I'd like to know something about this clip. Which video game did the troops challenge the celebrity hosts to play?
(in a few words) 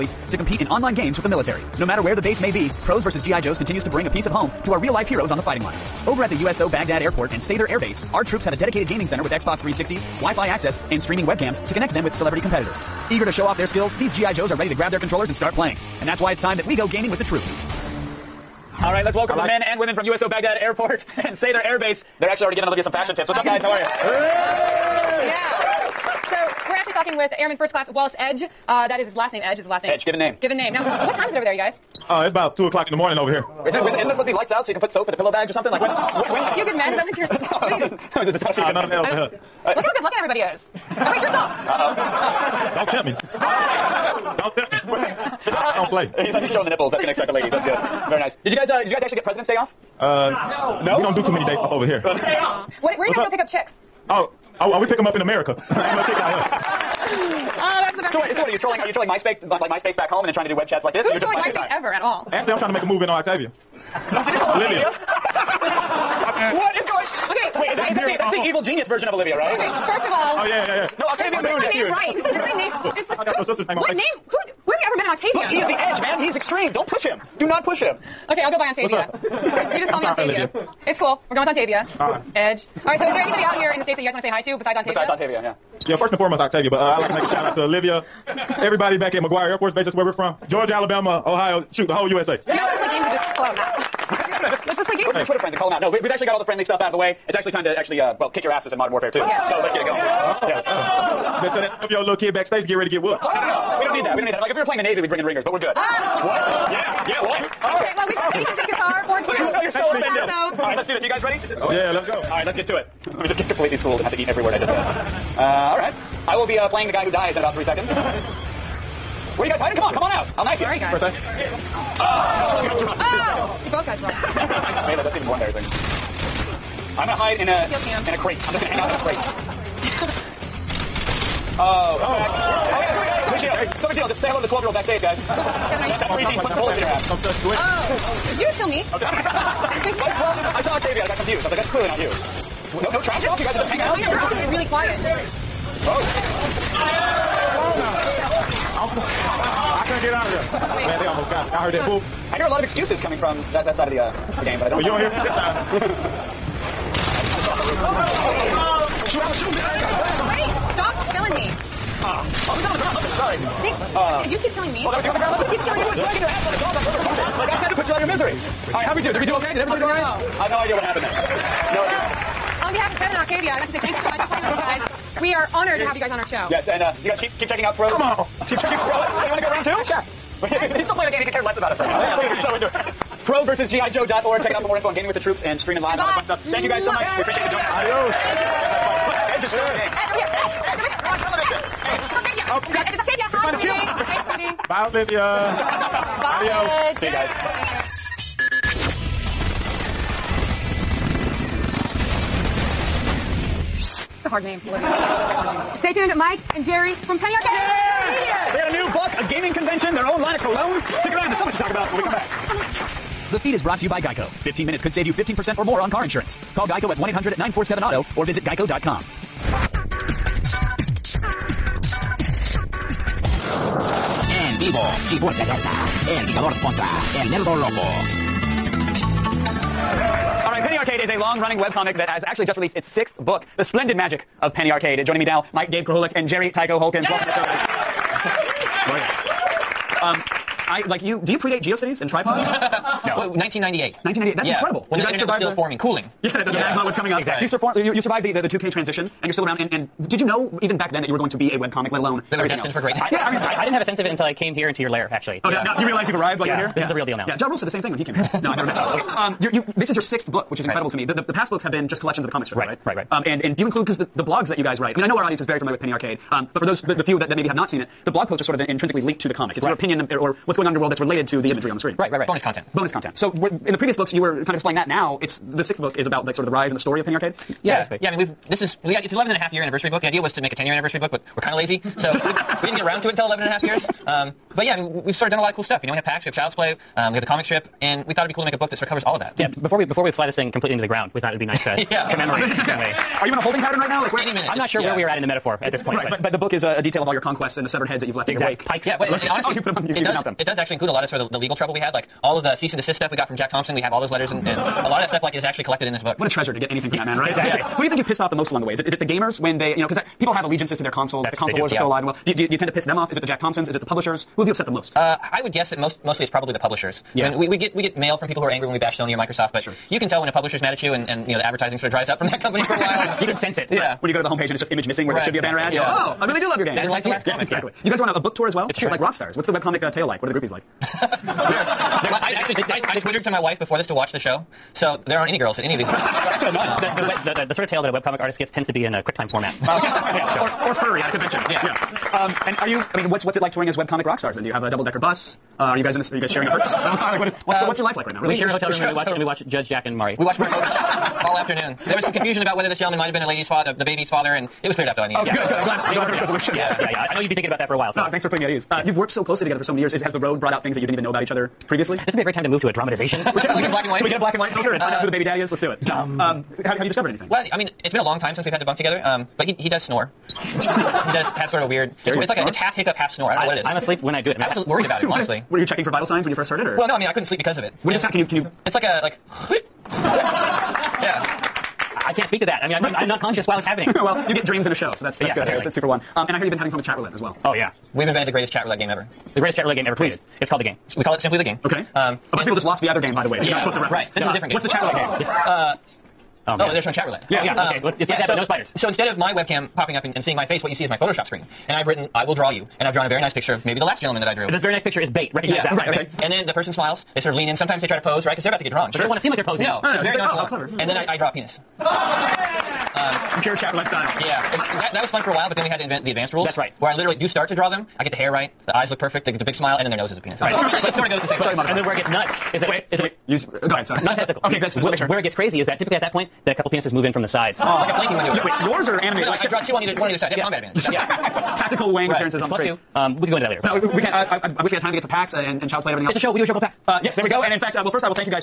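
Modern Warfare 2.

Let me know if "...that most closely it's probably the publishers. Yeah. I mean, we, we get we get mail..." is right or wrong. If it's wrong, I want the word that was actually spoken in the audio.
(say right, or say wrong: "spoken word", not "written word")
wrong: "mostly", not "closely".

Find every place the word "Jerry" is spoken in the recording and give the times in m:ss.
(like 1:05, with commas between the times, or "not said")
3:26, 3:56, 6:12.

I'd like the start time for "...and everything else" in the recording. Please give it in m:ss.
7:15.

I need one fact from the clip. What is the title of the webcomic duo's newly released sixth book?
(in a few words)
The Splendid Magic of Penny Arcade.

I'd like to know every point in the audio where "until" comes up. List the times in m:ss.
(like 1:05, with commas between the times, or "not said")
4:14, 4:43.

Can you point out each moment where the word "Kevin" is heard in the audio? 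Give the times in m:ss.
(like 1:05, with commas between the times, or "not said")
2:15, 2:52.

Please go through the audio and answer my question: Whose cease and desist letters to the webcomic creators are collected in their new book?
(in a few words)
Jack Thompson.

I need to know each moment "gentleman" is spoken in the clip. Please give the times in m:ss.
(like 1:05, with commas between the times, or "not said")
5:52, 6:43.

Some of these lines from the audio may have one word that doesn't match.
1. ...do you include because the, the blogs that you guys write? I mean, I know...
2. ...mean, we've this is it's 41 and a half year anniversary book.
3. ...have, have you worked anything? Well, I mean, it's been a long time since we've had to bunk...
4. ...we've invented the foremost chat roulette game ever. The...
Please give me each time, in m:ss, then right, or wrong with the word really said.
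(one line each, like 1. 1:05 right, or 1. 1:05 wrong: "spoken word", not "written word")
1. 4:23 right
2. 4:38 wrong: "11", not "41"
3. 6:06 wrong: "discovered", not "worked"
4. 6:27 wrong: "greatest", not "foremost".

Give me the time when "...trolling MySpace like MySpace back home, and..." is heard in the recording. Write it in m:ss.
0:58.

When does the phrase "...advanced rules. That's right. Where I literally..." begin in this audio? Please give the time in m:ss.
6:56.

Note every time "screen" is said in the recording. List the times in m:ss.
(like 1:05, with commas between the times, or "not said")
4:31, 6:41, 7:12.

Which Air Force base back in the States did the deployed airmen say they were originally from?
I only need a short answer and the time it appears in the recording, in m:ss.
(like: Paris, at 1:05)
McGuire Air Force Base, at 1:29.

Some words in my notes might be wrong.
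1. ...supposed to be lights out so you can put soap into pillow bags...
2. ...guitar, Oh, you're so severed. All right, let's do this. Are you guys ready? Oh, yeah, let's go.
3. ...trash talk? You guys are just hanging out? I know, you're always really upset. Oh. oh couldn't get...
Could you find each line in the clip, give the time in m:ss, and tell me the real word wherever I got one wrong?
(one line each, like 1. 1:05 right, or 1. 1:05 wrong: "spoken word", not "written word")
1. 0:34 right
2. 1:48 wrong: "offended", not "severed"
3. 2:23 wrong: "quiet", not "upset".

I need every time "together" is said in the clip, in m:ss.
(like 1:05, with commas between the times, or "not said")
5:59, 6:08.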